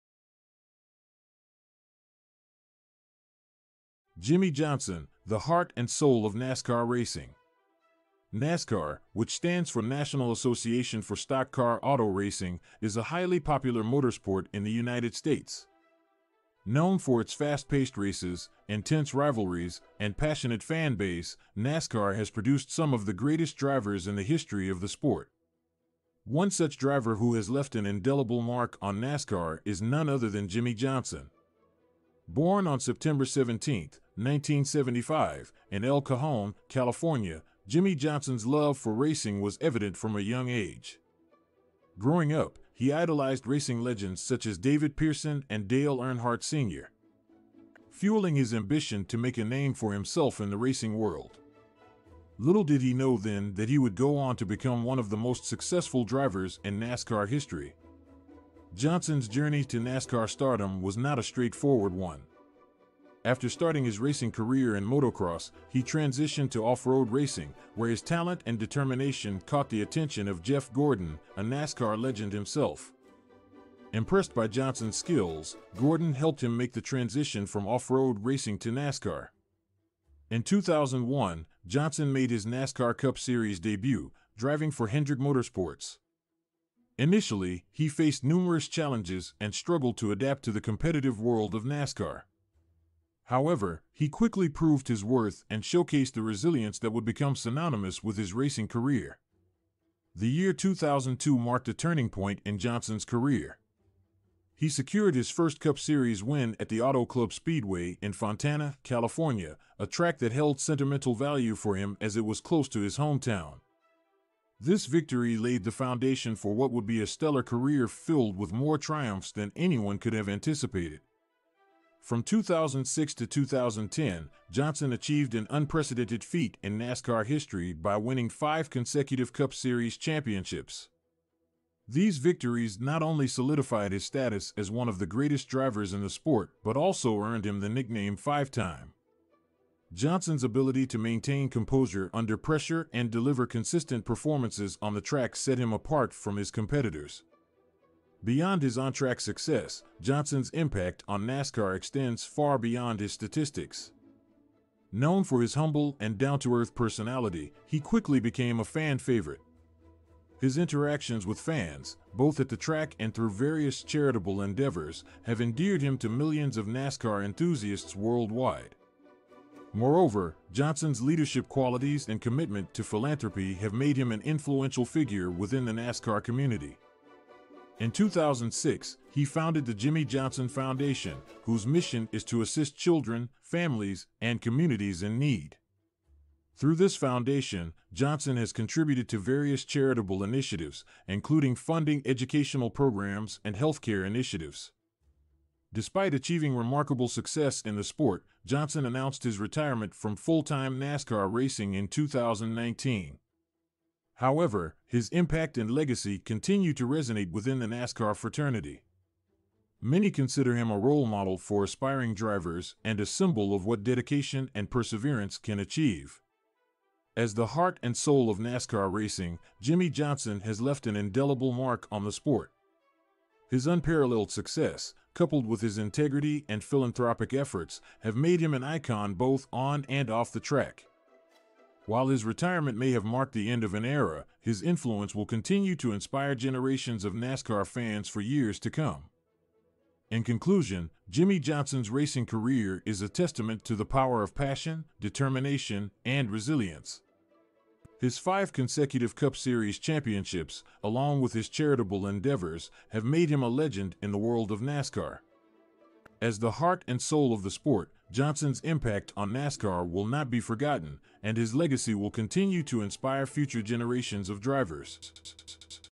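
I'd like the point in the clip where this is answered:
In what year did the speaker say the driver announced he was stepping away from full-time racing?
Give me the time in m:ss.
3:21.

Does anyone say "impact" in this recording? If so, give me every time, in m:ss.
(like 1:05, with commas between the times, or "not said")
2:30, 3:25, 4:18.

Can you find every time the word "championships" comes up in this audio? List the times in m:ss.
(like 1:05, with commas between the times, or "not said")
2:09, 4:09.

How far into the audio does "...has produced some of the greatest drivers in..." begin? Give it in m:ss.
0:22.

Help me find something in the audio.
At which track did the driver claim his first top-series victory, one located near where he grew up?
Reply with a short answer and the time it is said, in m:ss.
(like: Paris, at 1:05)
Auto Club Speedway, at 1:46.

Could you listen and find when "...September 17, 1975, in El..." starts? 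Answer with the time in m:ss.
0:32.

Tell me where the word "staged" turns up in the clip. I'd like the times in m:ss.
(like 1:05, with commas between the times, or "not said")
not said.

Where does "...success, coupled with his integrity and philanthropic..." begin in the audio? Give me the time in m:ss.
3:44.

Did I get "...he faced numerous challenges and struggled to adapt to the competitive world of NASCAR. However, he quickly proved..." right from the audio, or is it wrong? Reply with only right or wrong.
right.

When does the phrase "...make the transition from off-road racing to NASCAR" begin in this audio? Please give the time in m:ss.
1:16.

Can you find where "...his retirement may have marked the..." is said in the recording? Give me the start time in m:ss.
3:52.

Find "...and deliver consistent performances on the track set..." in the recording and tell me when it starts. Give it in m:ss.
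2:22.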